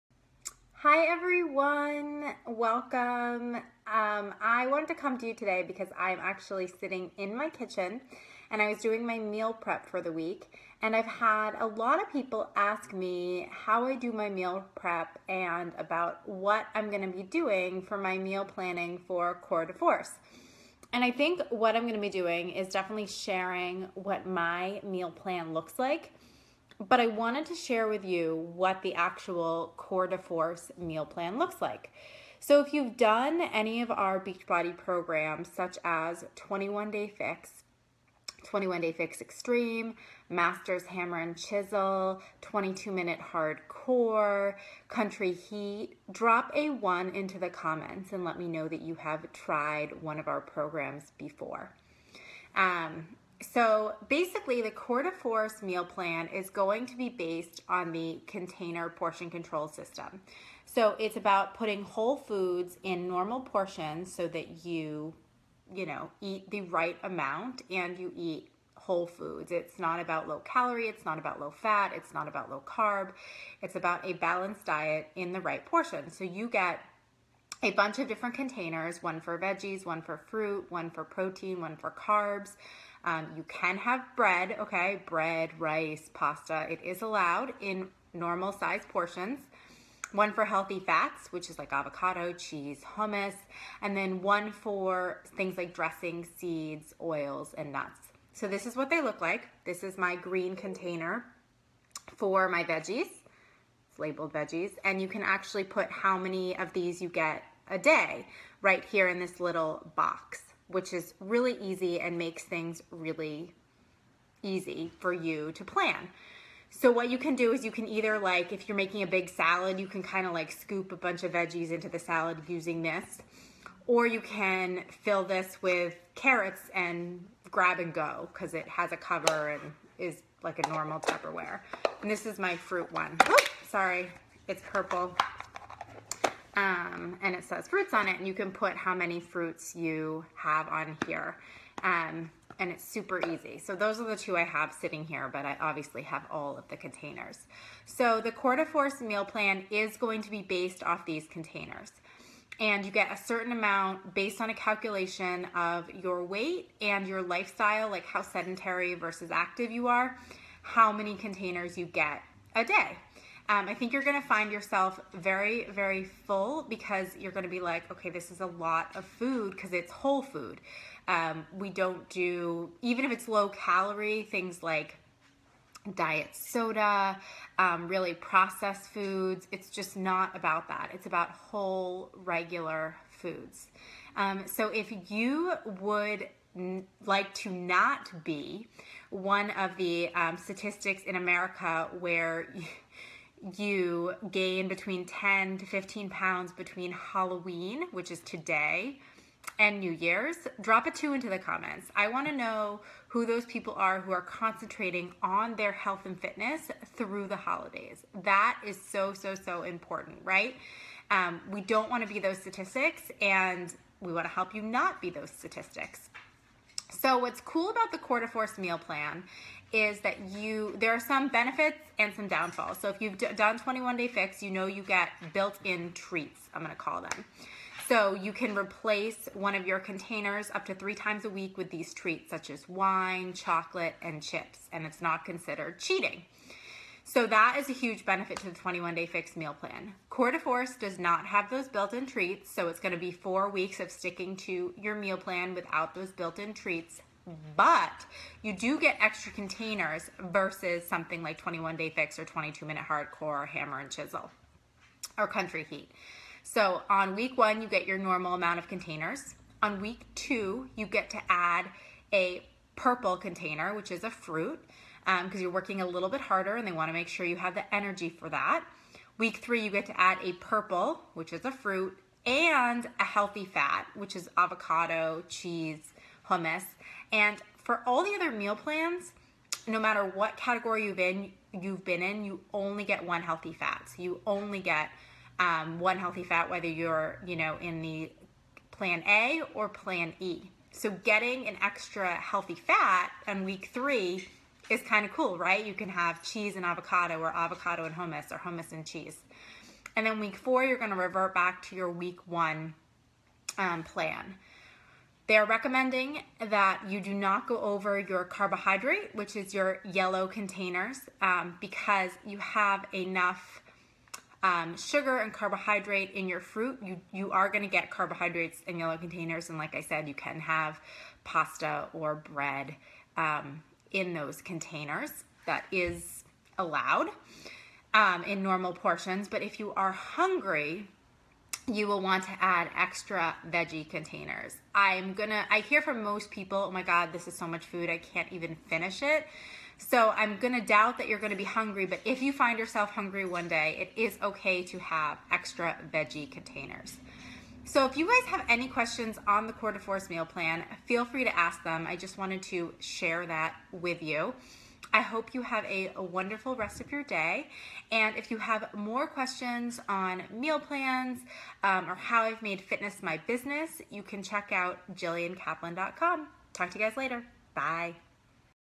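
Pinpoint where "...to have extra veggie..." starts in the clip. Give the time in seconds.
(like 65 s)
344 s.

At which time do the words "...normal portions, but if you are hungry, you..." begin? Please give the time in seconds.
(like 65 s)
328 s.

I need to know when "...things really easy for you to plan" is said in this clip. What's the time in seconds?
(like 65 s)
112 s.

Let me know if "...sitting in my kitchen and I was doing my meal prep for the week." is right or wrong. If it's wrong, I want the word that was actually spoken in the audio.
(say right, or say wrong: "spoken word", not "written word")
right.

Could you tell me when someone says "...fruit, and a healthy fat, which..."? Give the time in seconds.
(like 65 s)
271 s.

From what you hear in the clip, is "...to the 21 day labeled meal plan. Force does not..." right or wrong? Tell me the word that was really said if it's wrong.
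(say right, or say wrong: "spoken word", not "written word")
wrong: "fixed", not "labeled".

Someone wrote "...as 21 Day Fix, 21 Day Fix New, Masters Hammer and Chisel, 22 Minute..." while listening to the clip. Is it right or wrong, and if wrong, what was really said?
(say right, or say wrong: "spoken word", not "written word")
wrong: "Extreme", not "New".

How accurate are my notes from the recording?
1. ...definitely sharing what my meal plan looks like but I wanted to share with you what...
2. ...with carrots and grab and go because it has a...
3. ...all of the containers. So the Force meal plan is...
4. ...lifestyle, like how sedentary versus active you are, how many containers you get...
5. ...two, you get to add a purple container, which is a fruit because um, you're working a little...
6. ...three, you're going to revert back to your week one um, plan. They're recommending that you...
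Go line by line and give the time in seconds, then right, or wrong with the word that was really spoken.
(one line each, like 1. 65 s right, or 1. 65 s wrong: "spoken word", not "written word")
1. 22 s right
2. 125 s right
3. 146 s right
4. 157 s right
5. 260 s right
6. 300 s wrong: "four", not "three".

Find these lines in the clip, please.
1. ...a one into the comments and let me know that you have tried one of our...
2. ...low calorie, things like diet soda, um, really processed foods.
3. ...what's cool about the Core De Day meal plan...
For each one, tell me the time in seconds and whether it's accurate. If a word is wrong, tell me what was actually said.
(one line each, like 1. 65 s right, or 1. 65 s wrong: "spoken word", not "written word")
1. 46 s right
2. 173 s right
3. 217 s wrong: "Force", not "Day".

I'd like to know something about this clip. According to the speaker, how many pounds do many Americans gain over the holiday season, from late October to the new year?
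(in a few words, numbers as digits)
10 to 15 pounds.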